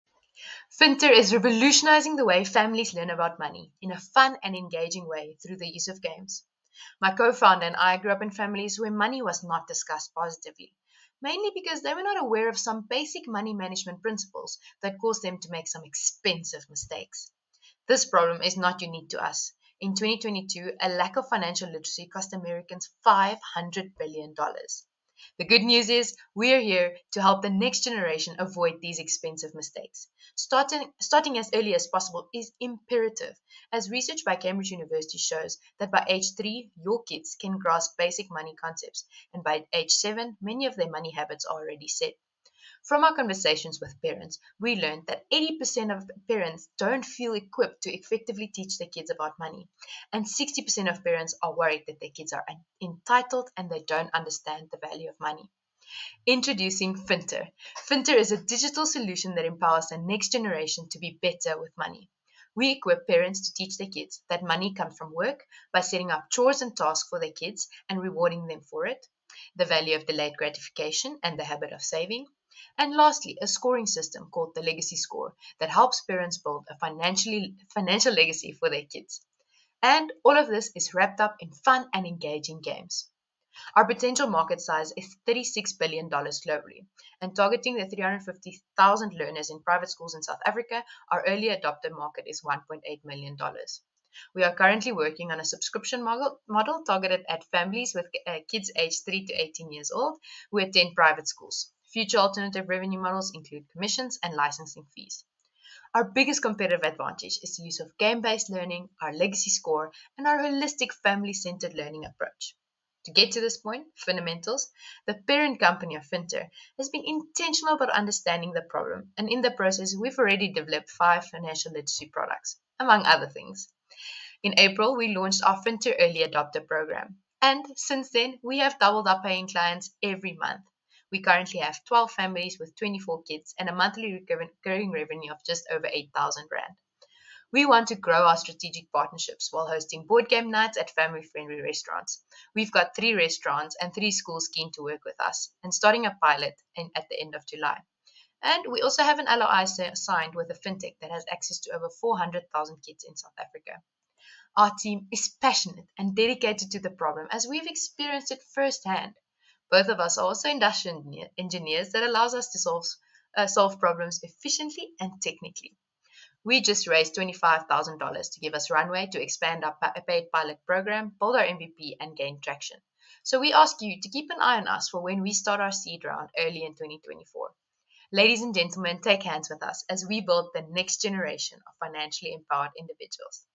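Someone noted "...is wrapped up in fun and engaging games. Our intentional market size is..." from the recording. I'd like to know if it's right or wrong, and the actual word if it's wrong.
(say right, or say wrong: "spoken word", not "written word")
wrong: "potential", not "intentional".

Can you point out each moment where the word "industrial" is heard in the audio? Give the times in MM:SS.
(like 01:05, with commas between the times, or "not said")
02:40.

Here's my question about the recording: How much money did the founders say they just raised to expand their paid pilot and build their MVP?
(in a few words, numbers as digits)
$25,000.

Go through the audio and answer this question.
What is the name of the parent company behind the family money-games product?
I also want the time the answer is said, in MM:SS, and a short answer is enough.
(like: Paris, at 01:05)
Fundamentals, at 01:53.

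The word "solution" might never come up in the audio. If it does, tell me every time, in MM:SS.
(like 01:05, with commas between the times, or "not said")
00:58.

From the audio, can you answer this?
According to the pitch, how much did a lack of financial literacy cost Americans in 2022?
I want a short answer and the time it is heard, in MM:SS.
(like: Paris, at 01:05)
$500 billion, at 00:23.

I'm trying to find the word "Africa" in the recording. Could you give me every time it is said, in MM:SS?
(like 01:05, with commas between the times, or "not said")
01:30, 02:33.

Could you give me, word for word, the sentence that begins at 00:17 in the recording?
This problem is not unique to us.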